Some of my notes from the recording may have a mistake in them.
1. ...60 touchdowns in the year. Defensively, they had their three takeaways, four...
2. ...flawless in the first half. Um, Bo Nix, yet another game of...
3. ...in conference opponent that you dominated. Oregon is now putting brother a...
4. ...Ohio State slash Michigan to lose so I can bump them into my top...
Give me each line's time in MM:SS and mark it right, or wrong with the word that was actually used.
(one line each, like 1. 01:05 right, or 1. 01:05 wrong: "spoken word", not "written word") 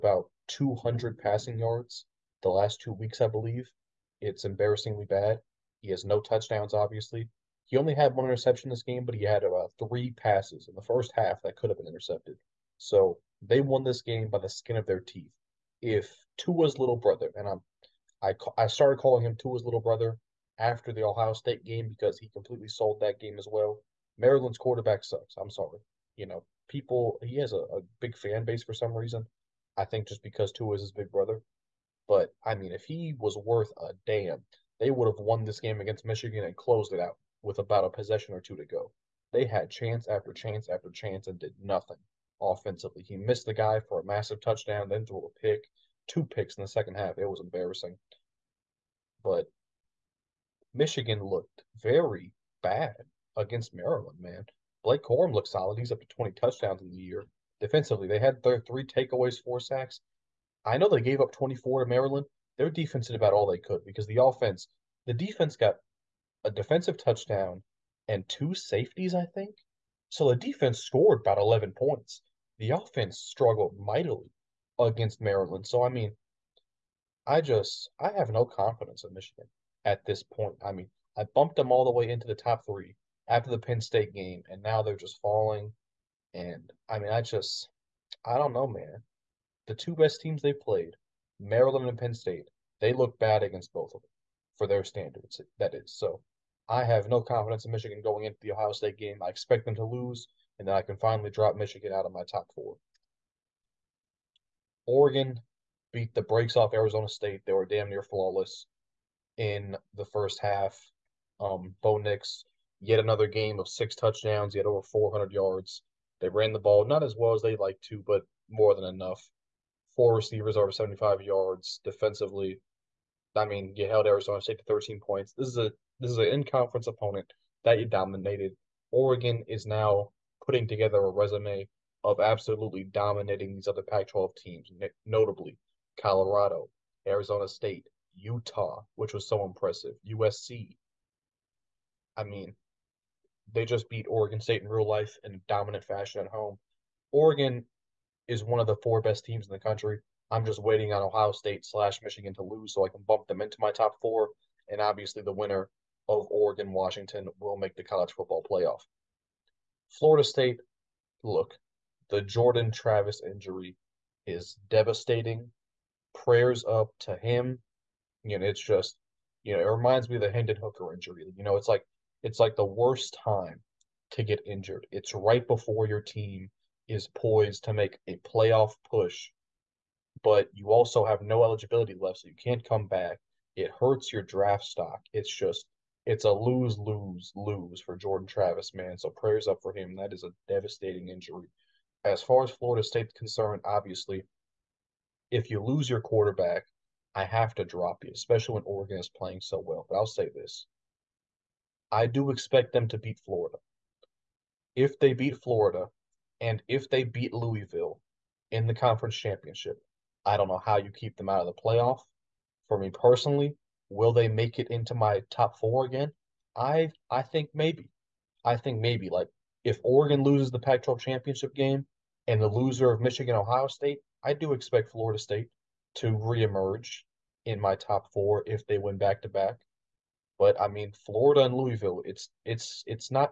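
1. 00:56 wrong: "20", not "60"
2. 01:48 right
3. 02:06 wrong: "together", not "brother"
4. 02:31 right.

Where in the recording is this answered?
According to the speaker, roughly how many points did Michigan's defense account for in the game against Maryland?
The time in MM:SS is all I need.
01:11.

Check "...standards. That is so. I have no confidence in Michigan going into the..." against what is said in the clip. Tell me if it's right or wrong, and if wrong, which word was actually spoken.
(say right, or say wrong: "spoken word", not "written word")
right.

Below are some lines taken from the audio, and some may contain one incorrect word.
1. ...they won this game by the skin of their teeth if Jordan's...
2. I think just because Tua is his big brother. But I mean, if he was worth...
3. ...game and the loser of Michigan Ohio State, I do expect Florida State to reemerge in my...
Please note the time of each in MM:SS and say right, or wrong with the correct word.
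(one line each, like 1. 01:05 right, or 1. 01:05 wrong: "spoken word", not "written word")
1. 00:13 wrong: "Tua", not "Jordan"
2. 00:29 right
3. 03:41 right.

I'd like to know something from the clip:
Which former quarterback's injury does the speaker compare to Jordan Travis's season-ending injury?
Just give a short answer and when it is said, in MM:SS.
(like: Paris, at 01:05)
Hendon Hooker, at 02:50.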